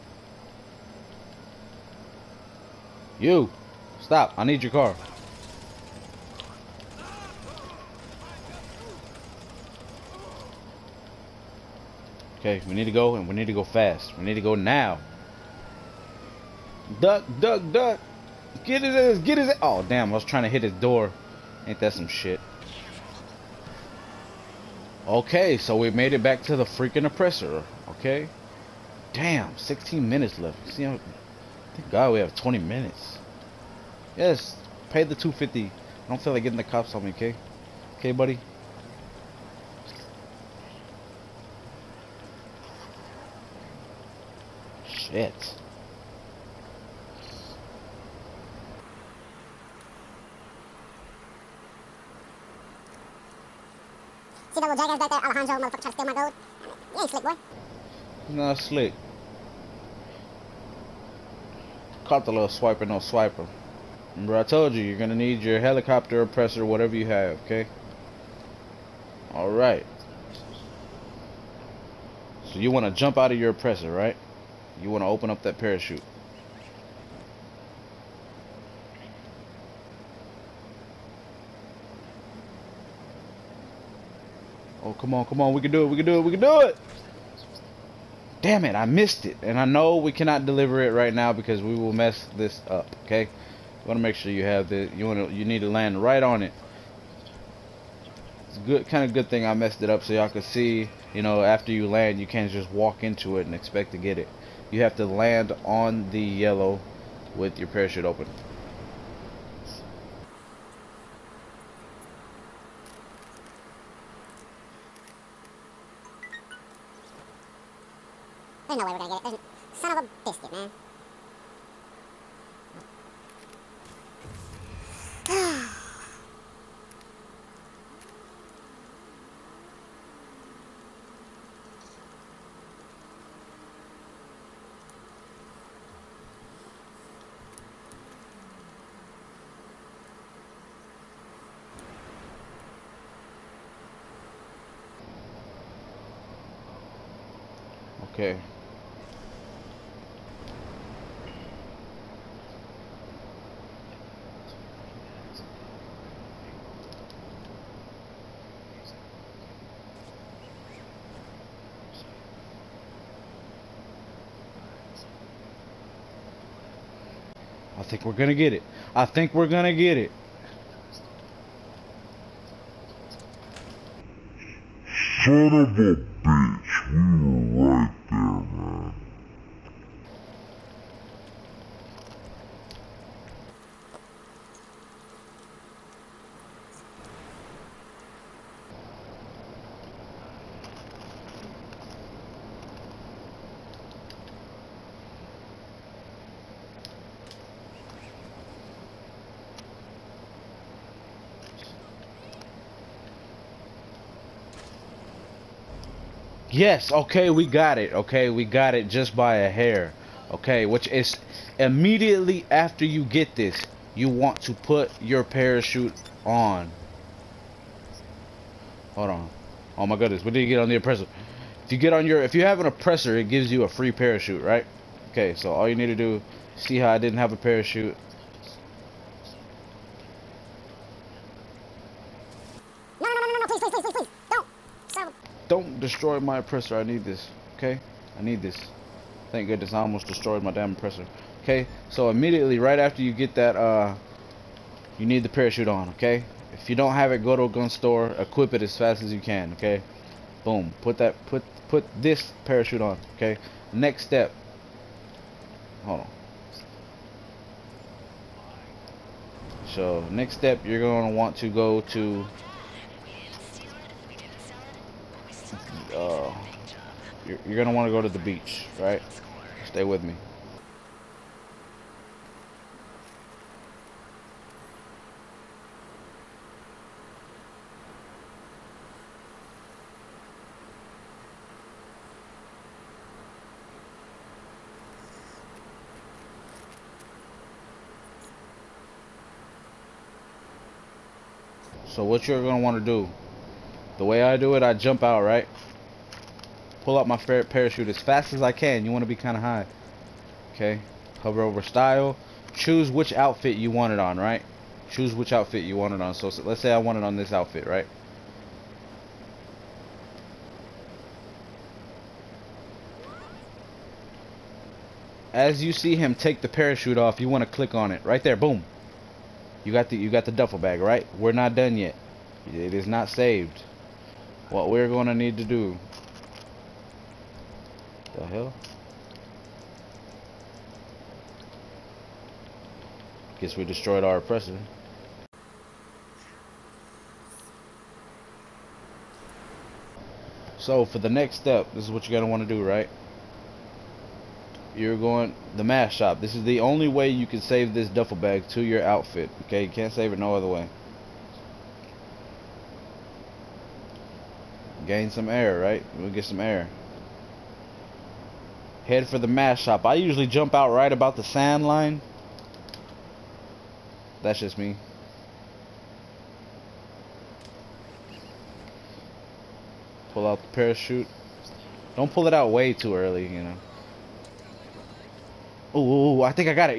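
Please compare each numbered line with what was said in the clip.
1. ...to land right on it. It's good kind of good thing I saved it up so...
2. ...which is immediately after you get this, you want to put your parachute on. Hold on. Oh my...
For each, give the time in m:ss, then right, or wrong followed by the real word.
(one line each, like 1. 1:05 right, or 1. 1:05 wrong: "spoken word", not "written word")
1. 1:35 wrong: "messed", not "saved"
2. 3:30 right.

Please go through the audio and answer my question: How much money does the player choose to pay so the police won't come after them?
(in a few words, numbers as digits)
250.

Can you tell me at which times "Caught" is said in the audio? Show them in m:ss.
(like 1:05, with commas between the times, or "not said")
1:02.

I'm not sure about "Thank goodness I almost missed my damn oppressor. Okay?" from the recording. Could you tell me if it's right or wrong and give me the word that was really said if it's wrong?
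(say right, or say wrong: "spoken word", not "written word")
wrong: "destroyed", not "missed".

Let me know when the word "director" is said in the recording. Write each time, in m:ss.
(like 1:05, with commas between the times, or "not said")
not said.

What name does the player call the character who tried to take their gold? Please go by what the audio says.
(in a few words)
Alejandro.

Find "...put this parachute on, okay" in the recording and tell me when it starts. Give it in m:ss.
4:11.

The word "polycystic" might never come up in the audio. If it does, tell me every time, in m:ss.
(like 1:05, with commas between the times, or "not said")
not said.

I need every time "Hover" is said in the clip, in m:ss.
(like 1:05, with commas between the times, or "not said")
5:01.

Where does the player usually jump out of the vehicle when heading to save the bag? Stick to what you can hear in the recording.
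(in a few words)
the sand line.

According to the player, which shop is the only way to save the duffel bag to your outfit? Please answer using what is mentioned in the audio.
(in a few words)
mask shop.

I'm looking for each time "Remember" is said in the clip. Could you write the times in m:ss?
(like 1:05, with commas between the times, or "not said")
1:04.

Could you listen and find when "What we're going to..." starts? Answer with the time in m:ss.
5:24.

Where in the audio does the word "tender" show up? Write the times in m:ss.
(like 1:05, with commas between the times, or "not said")
not said.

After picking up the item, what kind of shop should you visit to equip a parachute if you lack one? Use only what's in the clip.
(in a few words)
gun store.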